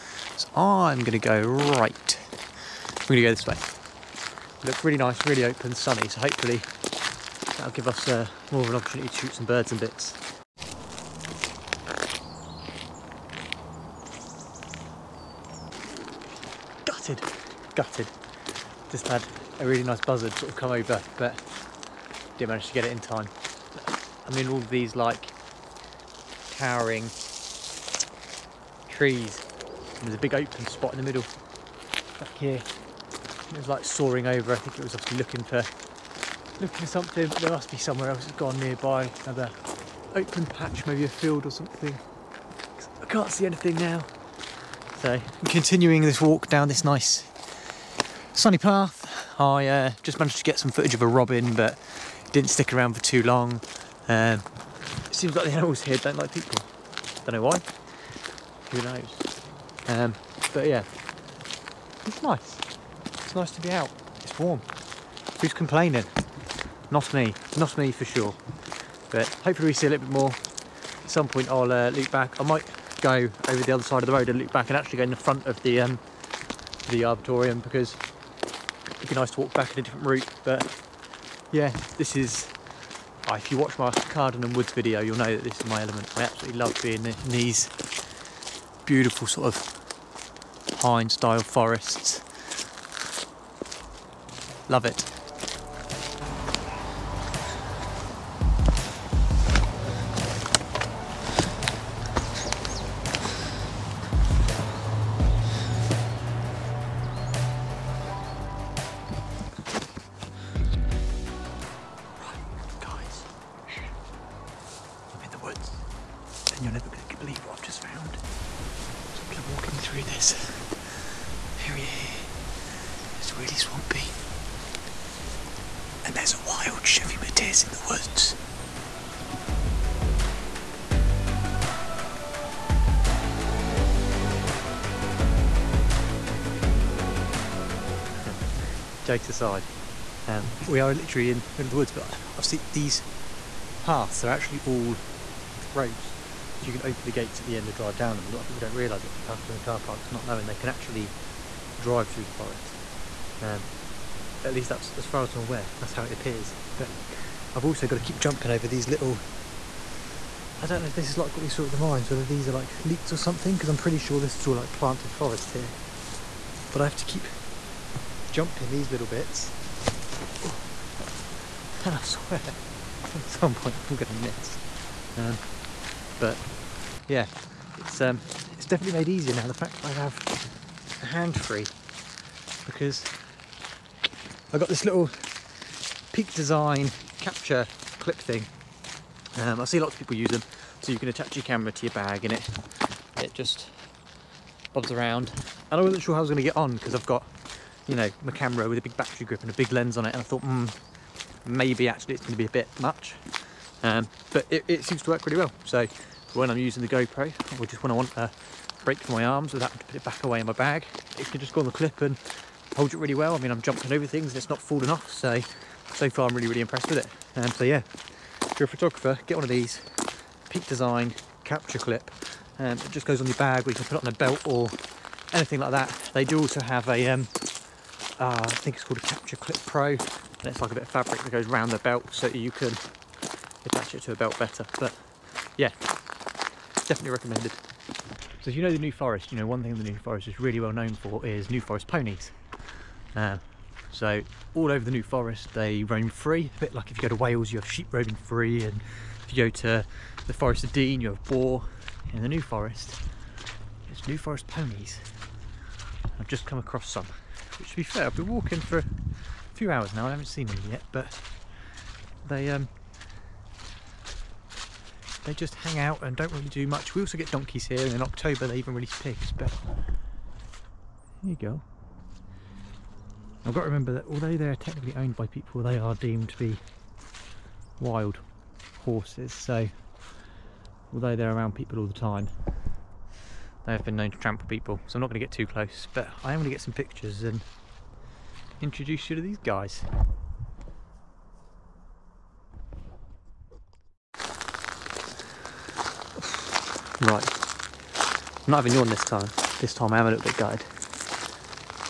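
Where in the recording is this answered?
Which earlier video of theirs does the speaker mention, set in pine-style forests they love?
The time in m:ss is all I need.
1:23.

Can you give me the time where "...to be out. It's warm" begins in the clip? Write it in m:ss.
1:03.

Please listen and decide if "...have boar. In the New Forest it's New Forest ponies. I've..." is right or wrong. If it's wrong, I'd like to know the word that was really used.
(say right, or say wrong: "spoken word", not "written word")
right.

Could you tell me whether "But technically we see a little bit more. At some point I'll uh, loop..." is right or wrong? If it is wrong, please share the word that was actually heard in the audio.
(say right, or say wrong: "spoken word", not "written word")
wrong: "hopefully", not "technically".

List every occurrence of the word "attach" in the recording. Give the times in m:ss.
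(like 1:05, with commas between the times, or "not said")
3:11, 3:53.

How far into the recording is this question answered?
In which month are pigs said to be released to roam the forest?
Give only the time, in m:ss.
4:28.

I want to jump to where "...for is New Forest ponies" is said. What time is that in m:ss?
4:00.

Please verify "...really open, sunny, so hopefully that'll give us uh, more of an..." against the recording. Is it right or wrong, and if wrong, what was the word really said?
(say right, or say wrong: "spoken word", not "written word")
right.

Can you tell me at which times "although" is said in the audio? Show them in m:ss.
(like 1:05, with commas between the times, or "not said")
4:34, 4:40.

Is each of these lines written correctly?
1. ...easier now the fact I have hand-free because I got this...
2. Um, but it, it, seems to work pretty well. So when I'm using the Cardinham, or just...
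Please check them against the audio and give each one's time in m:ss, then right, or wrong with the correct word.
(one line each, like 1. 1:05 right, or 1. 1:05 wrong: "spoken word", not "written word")
1. 2:59 right
2. 3:23 wrong: "GoPro", not "Cardinham".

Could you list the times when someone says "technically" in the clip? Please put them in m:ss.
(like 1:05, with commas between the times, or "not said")
4:34.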